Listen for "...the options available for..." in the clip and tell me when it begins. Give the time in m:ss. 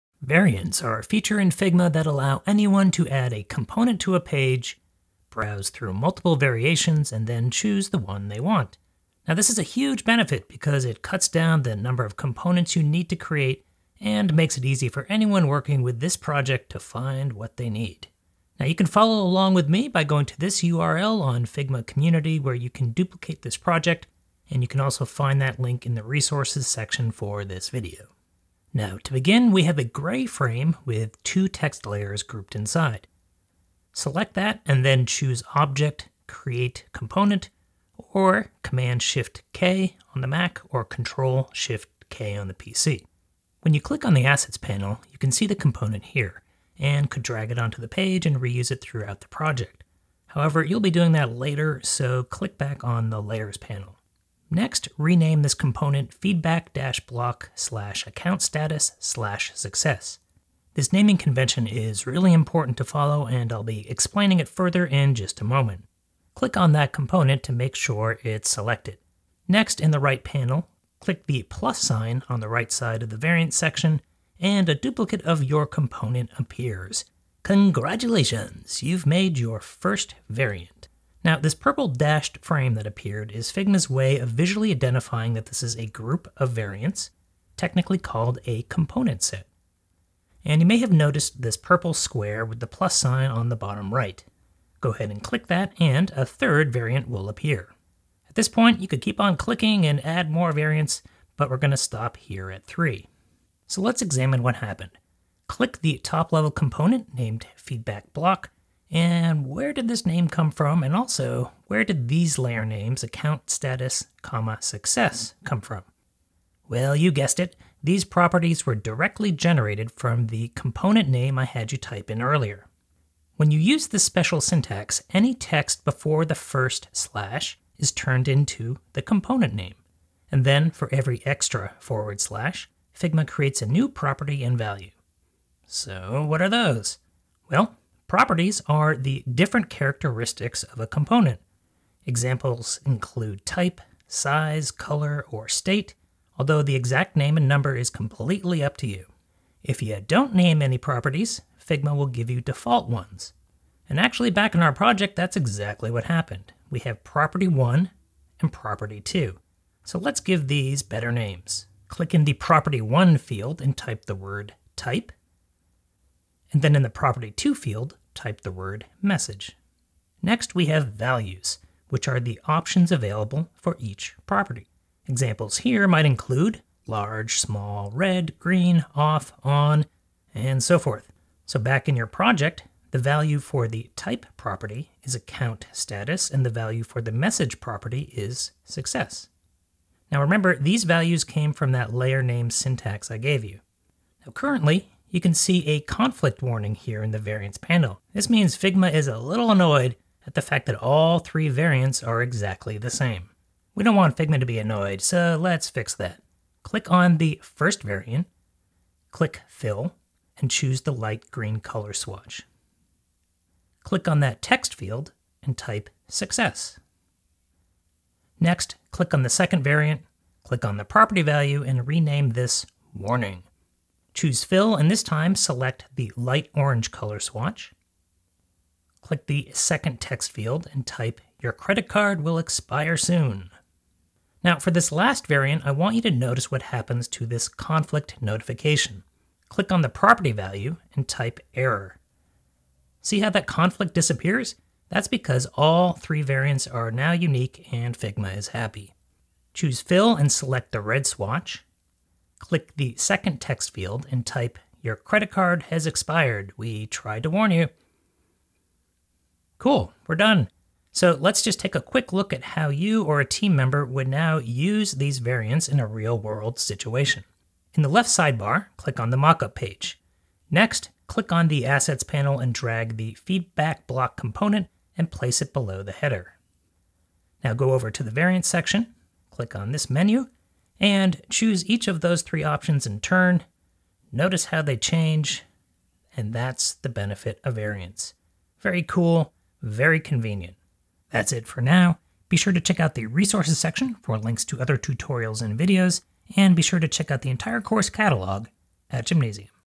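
2:52.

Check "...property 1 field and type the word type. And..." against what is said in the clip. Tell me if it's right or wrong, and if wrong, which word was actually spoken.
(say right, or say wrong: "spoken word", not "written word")
right.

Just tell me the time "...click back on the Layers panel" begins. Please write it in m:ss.
0:52.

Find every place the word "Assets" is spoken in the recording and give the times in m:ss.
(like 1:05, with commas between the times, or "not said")
0:44, 4:31.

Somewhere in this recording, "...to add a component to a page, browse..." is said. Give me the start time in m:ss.
0:02.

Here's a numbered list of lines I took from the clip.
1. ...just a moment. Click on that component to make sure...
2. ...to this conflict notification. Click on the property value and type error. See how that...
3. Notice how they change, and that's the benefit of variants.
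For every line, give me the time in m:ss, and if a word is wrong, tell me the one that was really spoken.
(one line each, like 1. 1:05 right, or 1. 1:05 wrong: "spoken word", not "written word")
1. 1:05 right
2. 3:57 right
3. 4:44 right.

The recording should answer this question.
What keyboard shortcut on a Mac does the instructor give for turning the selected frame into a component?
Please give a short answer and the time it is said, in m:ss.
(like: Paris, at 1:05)
Command-Shift-K, at 0:38.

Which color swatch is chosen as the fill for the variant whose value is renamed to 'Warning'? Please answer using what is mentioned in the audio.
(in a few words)
light orange.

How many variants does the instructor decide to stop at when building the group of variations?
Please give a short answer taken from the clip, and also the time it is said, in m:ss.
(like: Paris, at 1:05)
3, at 1:42.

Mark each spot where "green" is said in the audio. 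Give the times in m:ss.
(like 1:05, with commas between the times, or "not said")
2:58, 3:31.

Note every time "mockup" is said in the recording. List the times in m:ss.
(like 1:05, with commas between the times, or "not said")
4:29.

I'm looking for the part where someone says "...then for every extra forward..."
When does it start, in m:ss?
2:10.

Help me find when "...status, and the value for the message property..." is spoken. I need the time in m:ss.
3:05.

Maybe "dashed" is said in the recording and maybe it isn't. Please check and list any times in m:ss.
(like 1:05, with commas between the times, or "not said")
1:21.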